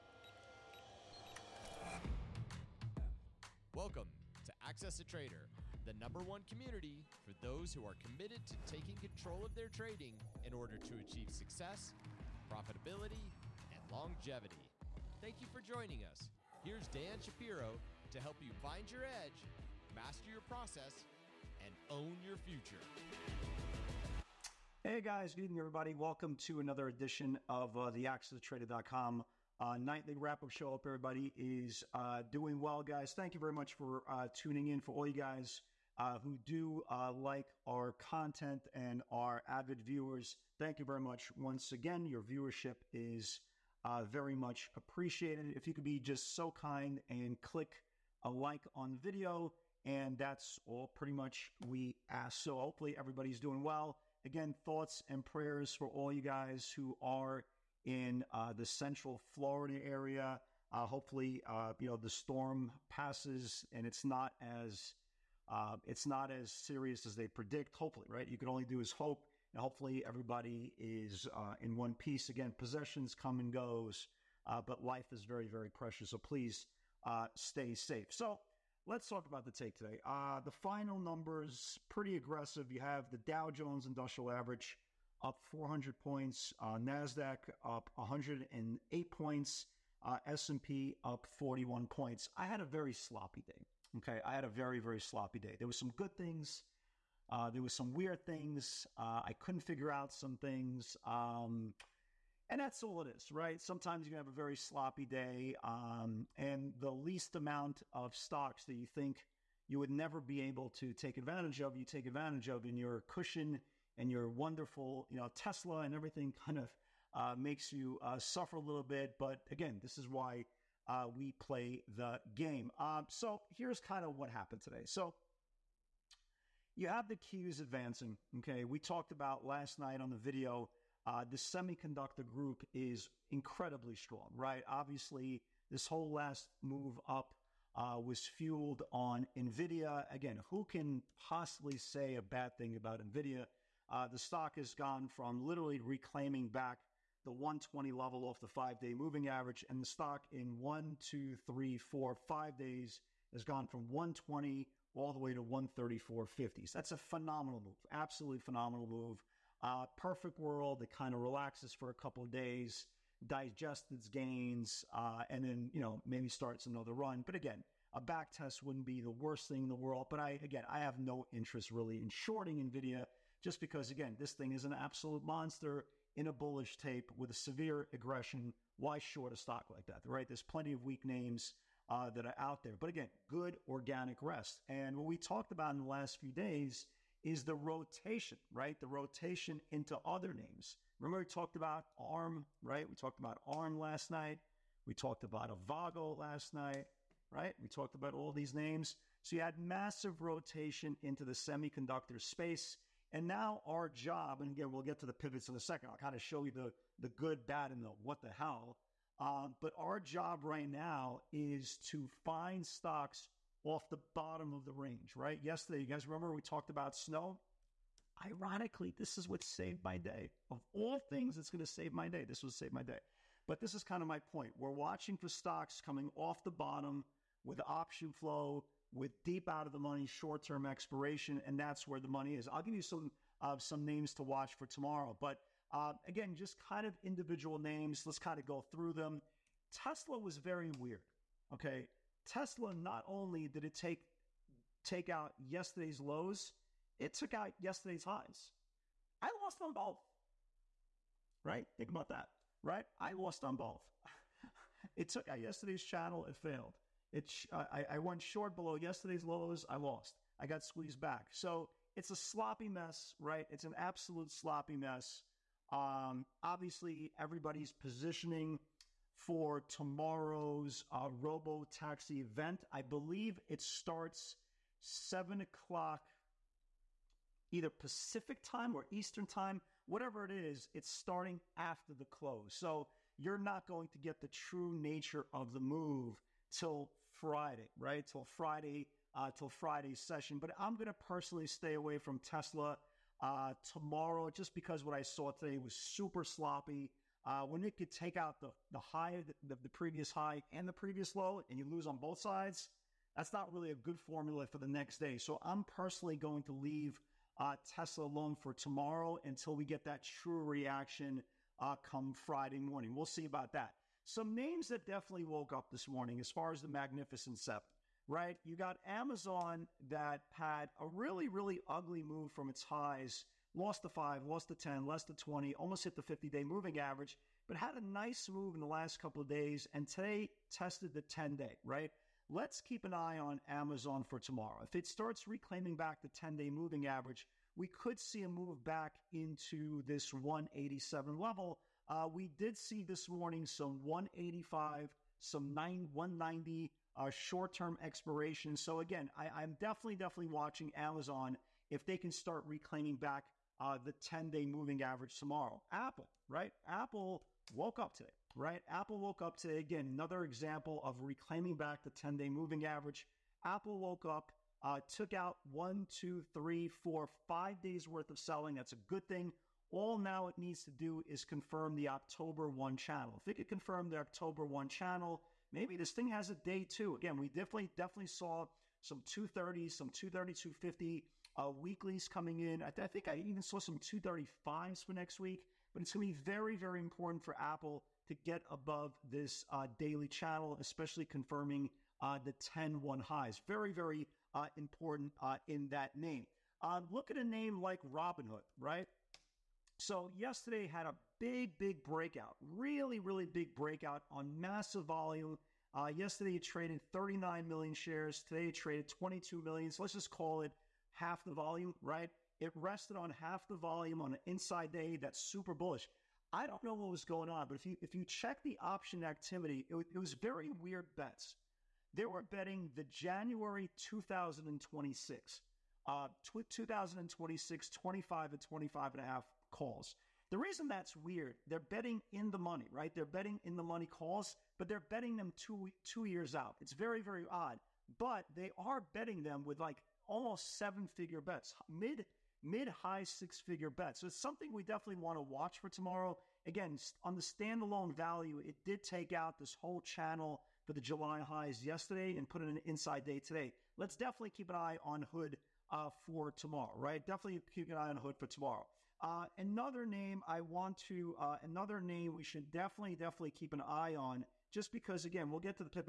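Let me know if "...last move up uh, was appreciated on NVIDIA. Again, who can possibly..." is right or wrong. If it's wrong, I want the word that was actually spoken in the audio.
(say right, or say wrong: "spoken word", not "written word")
wrong: "fueled", not "appreciated".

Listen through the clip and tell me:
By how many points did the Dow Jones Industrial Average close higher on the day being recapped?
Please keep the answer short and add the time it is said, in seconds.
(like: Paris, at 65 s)
400, at 85 s.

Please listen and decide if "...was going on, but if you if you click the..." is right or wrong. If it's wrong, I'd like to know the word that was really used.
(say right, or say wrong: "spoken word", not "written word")
wrong: "check", not "click".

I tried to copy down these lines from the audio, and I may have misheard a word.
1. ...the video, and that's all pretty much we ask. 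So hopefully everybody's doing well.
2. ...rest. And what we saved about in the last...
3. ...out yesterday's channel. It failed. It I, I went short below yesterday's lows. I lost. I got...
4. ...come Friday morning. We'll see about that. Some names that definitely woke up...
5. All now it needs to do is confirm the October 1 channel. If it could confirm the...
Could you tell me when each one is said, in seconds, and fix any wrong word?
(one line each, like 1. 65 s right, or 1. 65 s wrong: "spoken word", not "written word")
1. 48 s right
2. 184 s wrong: "talked", not "saved"
3. 255 s right
4. 311 s right
5. 369 s right.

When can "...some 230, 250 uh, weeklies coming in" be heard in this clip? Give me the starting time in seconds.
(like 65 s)
379 s.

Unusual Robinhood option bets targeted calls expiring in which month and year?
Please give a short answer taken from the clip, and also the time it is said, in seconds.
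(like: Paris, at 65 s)
January 2026, at 422 s.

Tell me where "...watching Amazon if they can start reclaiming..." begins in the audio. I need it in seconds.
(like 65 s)
350 s.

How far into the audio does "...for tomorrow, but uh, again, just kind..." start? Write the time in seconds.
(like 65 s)
234 s.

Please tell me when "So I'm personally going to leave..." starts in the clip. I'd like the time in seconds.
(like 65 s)
305 s.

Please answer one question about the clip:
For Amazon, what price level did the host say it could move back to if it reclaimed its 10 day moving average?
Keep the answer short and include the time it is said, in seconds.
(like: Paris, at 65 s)
187, at 340 s.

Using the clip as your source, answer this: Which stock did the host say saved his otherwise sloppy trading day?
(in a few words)
Snow.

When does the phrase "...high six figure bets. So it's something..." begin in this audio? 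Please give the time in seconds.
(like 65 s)
442 s.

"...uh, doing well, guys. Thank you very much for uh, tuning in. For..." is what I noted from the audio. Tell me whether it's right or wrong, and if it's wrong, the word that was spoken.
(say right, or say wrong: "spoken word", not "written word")
right.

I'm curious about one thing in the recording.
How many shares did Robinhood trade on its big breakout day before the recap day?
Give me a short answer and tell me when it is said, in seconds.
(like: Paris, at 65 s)
39 million, at 406 s.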